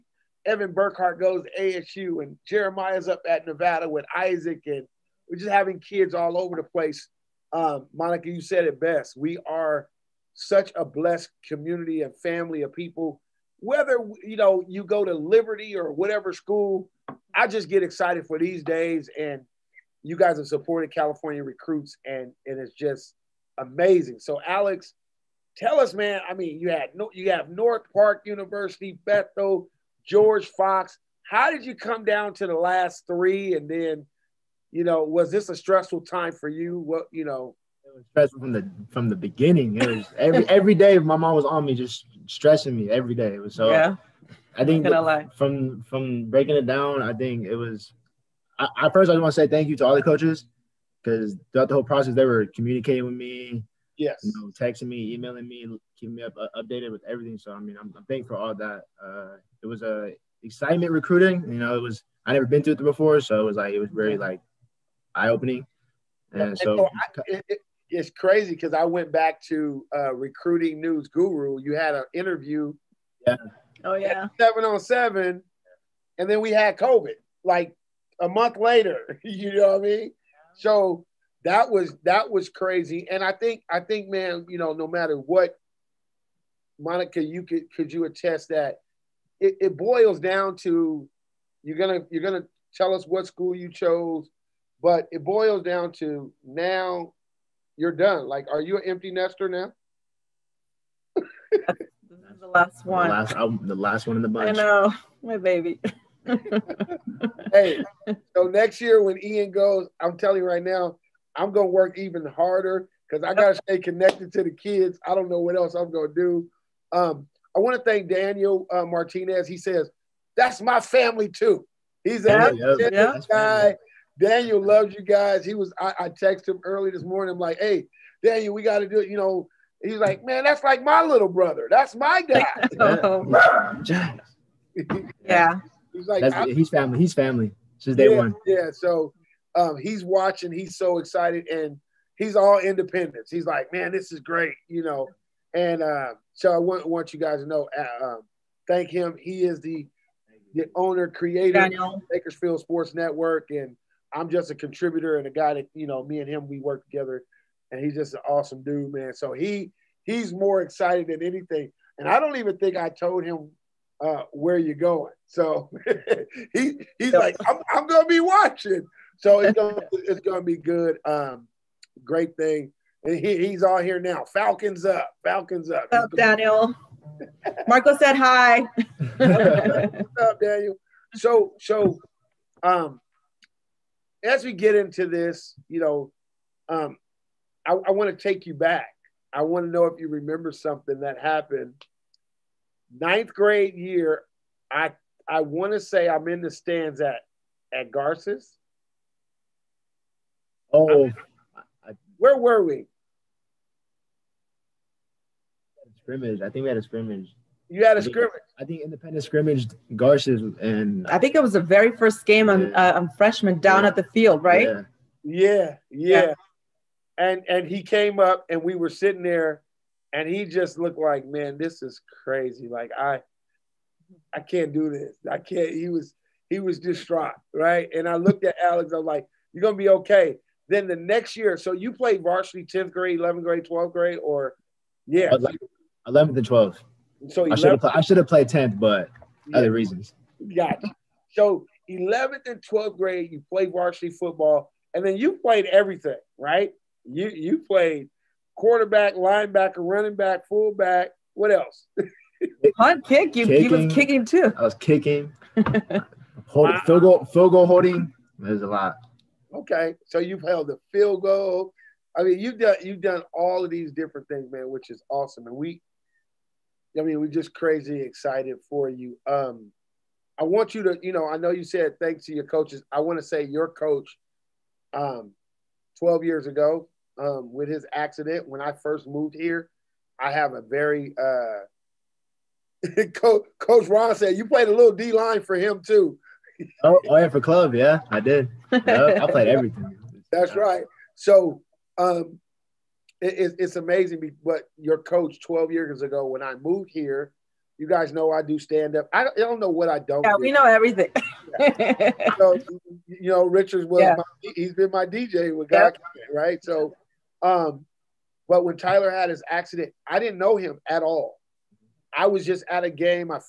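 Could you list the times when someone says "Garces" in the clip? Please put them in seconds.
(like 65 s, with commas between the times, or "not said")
197 s, 209 s.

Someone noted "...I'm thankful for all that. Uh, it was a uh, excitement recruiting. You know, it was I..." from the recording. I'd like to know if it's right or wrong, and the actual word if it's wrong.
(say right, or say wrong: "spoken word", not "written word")
right.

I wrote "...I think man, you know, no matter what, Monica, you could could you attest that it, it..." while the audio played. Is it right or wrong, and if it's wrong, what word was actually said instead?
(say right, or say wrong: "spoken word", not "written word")
right.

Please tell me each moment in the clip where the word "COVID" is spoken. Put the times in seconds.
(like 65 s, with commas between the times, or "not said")
76 s.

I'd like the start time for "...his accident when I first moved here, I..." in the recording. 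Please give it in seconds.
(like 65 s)
277 s.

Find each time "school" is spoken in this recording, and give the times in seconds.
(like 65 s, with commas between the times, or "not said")
16 s, 93 s.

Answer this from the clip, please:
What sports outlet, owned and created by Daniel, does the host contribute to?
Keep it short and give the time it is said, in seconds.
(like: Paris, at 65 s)
Bakersfield Sports Network, at 152 s.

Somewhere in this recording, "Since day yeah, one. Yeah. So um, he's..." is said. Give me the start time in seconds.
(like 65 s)
137 s.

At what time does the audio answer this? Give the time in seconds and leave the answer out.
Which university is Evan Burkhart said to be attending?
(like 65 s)
1 s.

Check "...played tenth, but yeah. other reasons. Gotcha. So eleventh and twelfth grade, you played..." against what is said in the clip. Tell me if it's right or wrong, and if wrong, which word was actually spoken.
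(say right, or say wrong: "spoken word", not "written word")
right.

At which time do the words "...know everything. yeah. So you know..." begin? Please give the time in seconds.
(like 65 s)
300 s.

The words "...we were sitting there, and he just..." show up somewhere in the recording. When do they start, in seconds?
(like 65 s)
218 s.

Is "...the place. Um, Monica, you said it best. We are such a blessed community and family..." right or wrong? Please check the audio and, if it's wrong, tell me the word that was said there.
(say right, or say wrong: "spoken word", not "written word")
right.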